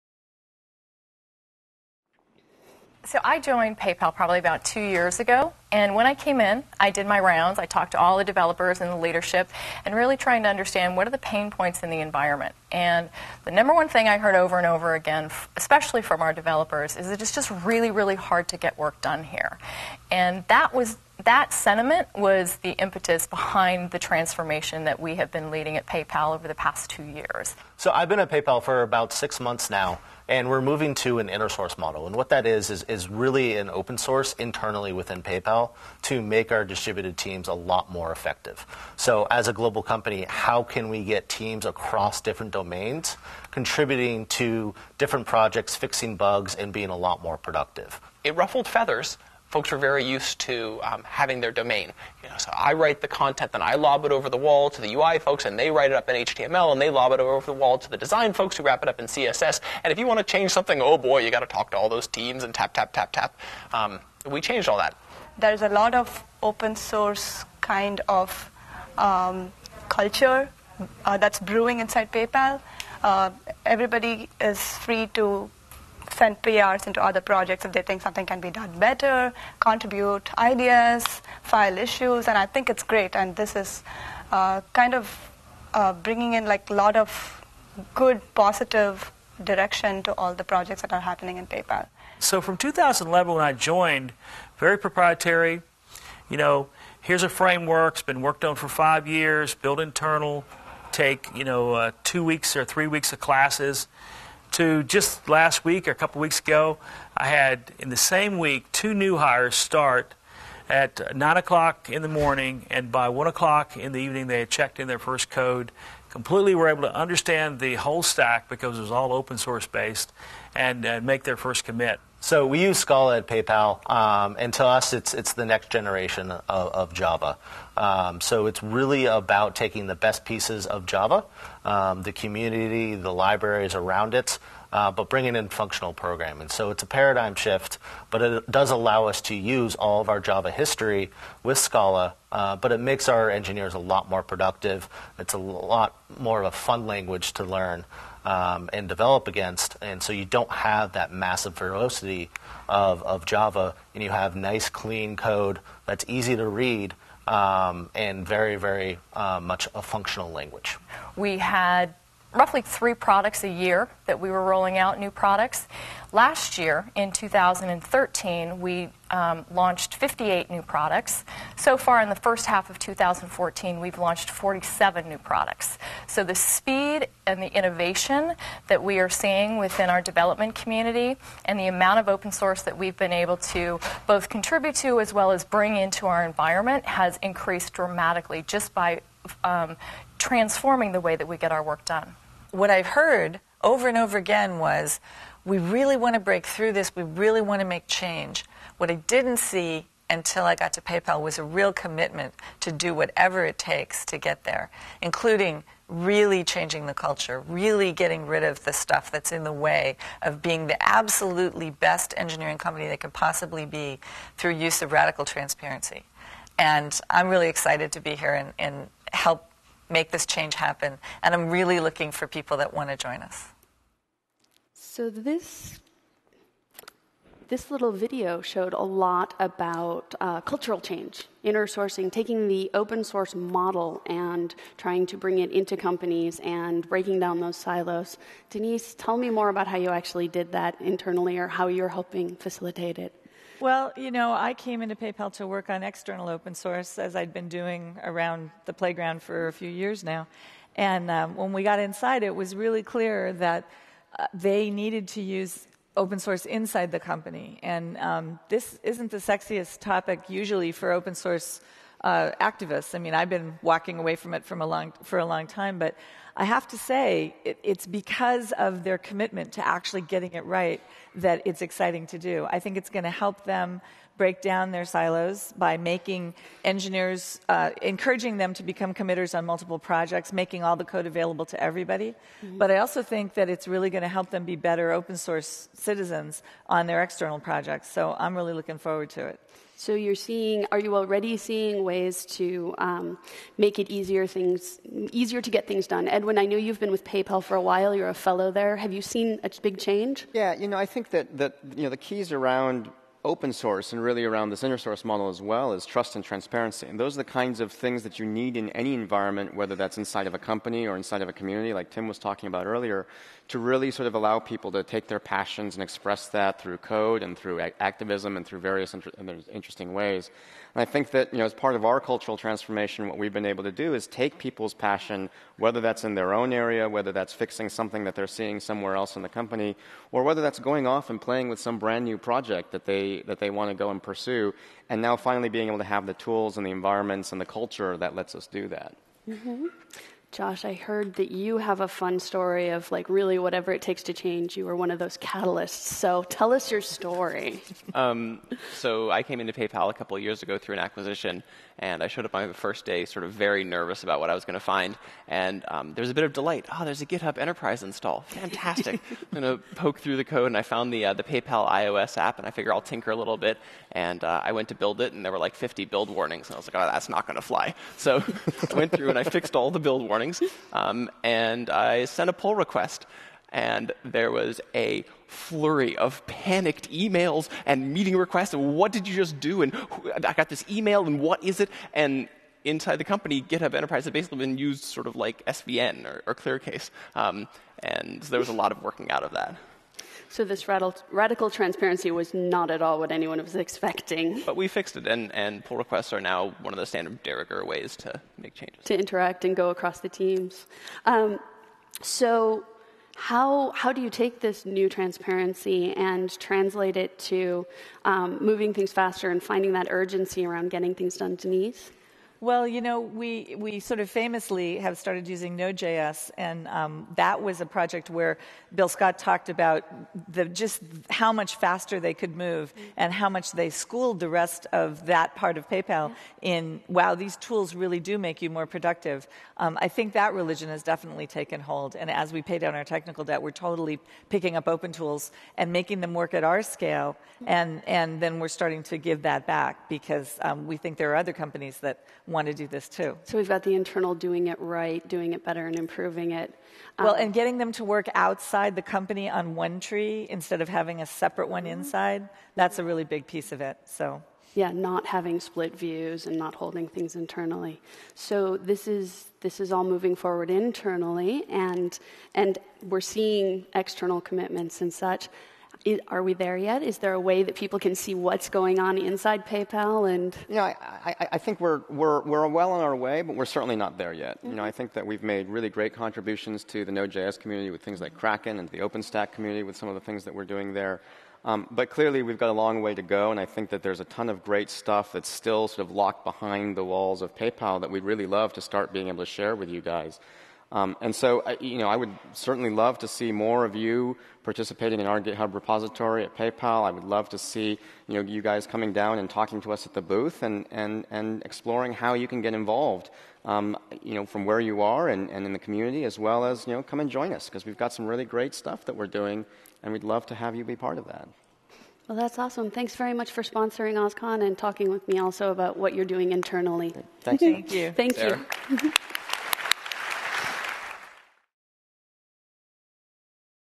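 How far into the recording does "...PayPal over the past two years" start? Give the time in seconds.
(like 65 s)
25 s.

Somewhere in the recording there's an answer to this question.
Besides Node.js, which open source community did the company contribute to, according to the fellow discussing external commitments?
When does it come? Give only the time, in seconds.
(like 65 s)
478 s.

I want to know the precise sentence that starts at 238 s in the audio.
Danese, tell me more about how you actually did that internally or how you're helping facilitate it.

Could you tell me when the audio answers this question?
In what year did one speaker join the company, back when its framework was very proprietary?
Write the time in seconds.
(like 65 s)
92 s.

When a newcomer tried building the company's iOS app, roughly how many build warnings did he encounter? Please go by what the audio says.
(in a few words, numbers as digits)
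50.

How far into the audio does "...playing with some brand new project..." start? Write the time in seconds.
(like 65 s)
331 s.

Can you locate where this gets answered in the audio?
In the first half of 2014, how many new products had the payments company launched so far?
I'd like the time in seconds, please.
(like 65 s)
174 s.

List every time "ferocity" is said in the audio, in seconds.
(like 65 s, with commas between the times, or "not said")
151 s.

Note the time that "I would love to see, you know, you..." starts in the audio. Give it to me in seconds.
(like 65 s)
496 s.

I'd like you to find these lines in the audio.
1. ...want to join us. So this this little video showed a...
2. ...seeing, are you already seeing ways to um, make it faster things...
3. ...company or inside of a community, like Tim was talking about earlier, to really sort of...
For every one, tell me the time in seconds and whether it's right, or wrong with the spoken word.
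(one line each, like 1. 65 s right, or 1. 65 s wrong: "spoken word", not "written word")
1. 222 s right
2. 290 s wrong: "easier", not "faster"
3. 310 s right.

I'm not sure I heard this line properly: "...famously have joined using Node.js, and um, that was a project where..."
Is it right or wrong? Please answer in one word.
wrong.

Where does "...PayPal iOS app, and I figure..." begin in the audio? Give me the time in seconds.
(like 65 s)
361 s.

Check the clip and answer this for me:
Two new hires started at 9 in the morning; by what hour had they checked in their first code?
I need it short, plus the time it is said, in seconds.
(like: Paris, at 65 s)
1 o'clock, at 113 s.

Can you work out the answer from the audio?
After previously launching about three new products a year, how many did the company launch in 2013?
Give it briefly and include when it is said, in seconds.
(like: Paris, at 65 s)
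58, at 169 s.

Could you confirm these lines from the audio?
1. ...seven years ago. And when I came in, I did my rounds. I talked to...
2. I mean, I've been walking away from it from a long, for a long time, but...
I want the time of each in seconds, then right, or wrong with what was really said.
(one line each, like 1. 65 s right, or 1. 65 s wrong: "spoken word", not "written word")
1. 4 s wrong: "two", not "seven"
2. 262 s right.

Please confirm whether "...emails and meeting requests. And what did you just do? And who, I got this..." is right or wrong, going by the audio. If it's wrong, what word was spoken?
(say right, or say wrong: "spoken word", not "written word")
right.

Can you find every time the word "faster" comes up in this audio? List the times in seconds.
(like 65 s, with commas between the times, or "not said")
408 s, 421 s.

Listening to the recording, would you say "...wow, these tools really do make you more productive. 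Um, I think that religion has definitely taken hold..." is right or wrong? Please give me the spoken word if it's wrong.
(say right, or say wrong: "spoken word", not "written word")
right.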